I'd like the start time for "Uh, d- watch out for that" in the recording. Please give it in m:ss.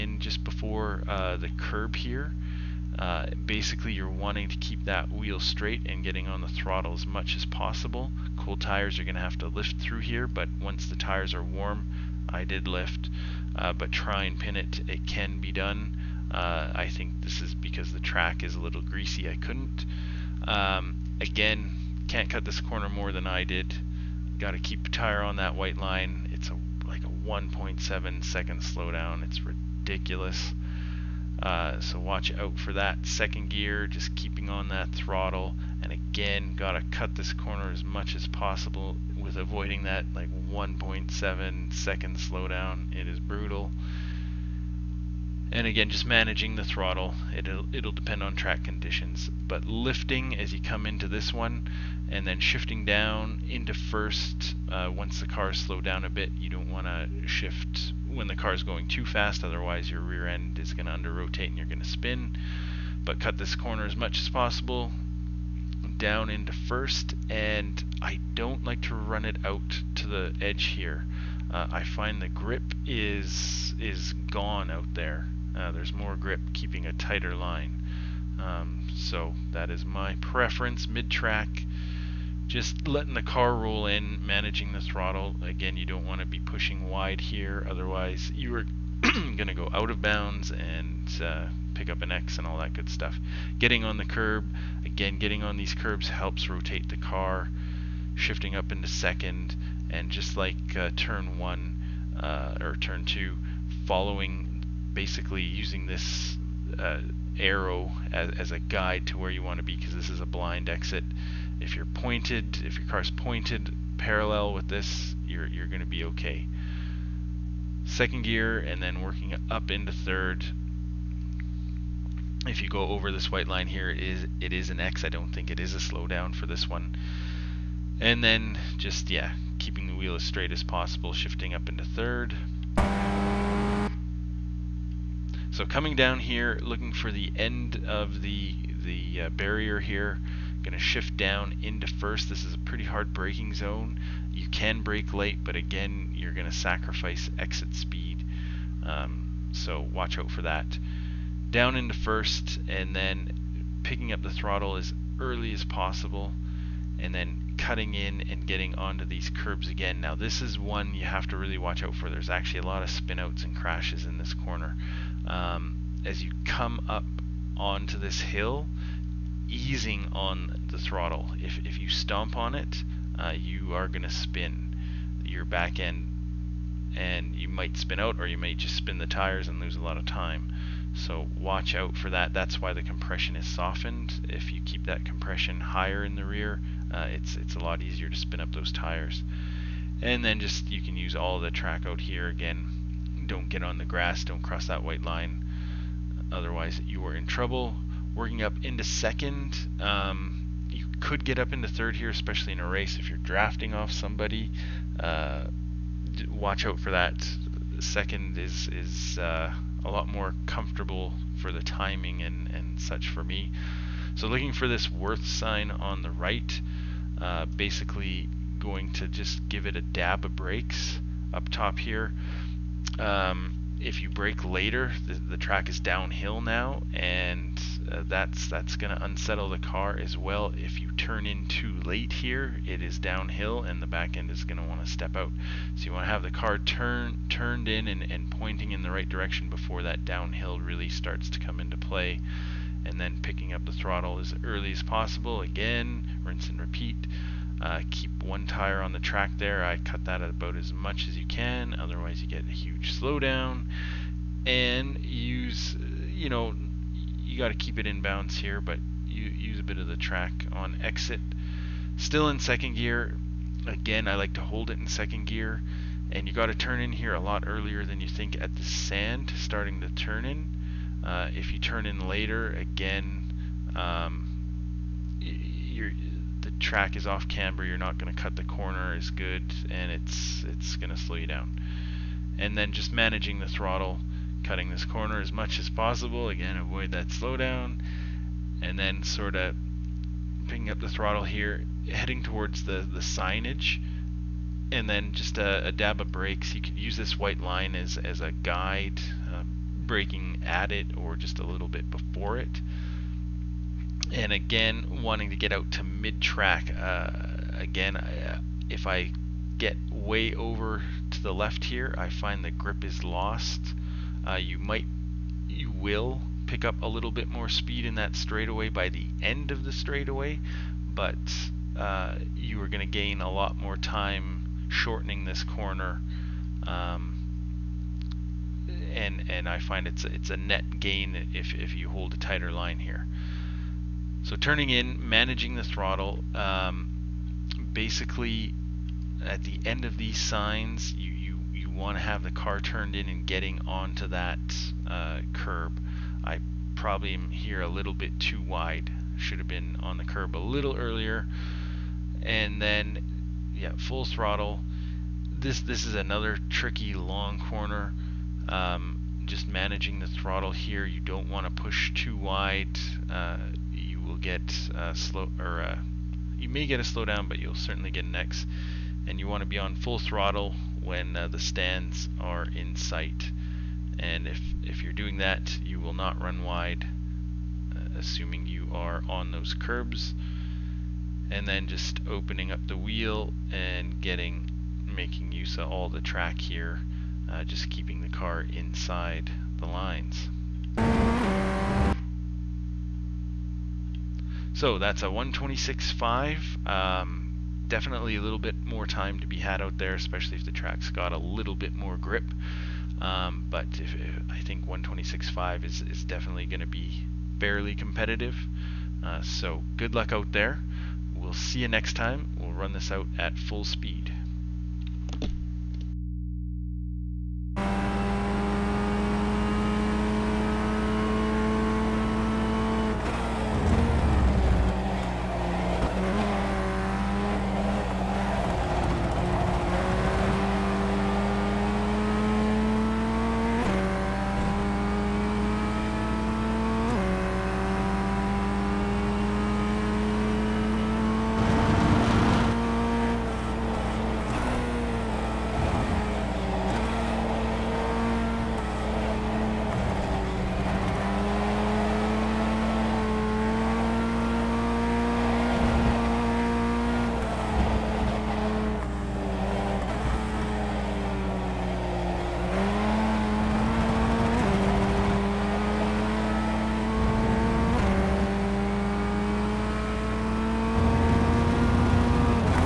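3:24.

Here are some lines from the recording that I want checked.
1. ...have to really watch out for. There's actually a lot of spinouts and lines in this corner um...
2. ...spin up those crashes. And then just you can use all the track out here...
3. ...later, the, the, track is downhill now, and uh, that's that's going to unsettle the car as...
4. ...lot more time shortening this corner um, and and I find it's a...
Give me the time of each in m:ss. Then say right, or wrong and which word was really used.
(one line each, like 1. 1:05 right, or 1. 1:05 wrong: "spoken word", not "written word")
1. 2:41 wrong: "crashes", not "lines"
2. 3:08 wrong: "tires", not "crashes"
3. 3:44 right
4. 5:23 right.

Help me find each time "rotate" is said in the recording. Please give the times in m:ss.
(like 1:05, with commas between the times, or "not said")
1:01, 1:36.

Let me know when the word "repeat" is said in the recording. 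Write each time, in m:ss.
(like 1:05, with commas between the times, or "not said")
4:06.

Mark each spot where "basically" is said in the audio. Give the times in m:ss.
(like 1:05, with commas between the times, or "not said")
0:03, 1:44, 3:37, 5:37.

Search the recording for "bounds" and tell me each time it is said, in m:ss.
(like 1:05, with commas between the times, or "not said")
1:30, 4:18.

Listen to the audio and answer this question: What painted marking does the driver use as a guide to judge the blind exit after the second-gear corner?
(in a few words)
Arrow.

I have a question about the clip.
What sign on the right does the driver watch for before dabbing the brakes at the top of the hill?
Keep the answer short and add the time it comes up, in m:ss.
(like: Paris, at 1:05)
Worth sign, at 3:34.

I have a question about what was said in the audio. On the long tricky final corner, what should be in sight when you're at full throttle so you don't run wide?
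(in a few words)
The stands.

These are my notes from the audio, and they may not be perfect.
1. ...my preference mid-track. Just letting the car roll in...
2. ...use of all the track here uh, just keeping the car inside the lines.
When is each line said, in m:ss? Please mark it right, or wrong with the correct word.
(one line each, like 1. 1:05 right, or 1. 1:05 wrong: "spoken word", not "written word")
1. 1:19 right
2. 6:25 right.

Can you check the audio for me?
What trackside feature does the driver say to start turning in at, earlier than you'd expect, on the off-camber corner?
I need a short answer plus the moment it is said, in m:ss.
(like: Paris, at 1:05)
The sand, at 4:28.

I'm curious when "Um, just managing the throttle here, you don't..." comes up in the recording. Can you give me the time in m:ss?
5:58.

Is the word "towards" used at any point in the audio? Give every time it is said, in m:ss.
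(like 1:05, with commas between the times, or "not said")
4:52.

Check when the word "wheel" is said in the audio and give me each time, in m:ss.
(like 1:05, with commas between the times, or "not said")
0:05, 2:09, 6:22.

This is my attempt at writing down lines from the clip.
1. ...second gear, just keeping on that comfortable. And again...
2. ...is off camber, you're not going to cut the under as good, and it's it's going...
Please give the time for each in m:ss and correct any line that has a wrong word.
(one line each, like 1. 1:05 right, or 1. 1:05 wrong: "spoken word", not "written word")
1. 0:33 wrong: "throttle", not "comfortable"
2. 4:36 wrong: "corner", not "under".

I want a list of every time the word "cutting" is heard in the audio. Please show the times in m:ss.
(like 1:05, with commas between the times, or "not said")
2:37, 4:44.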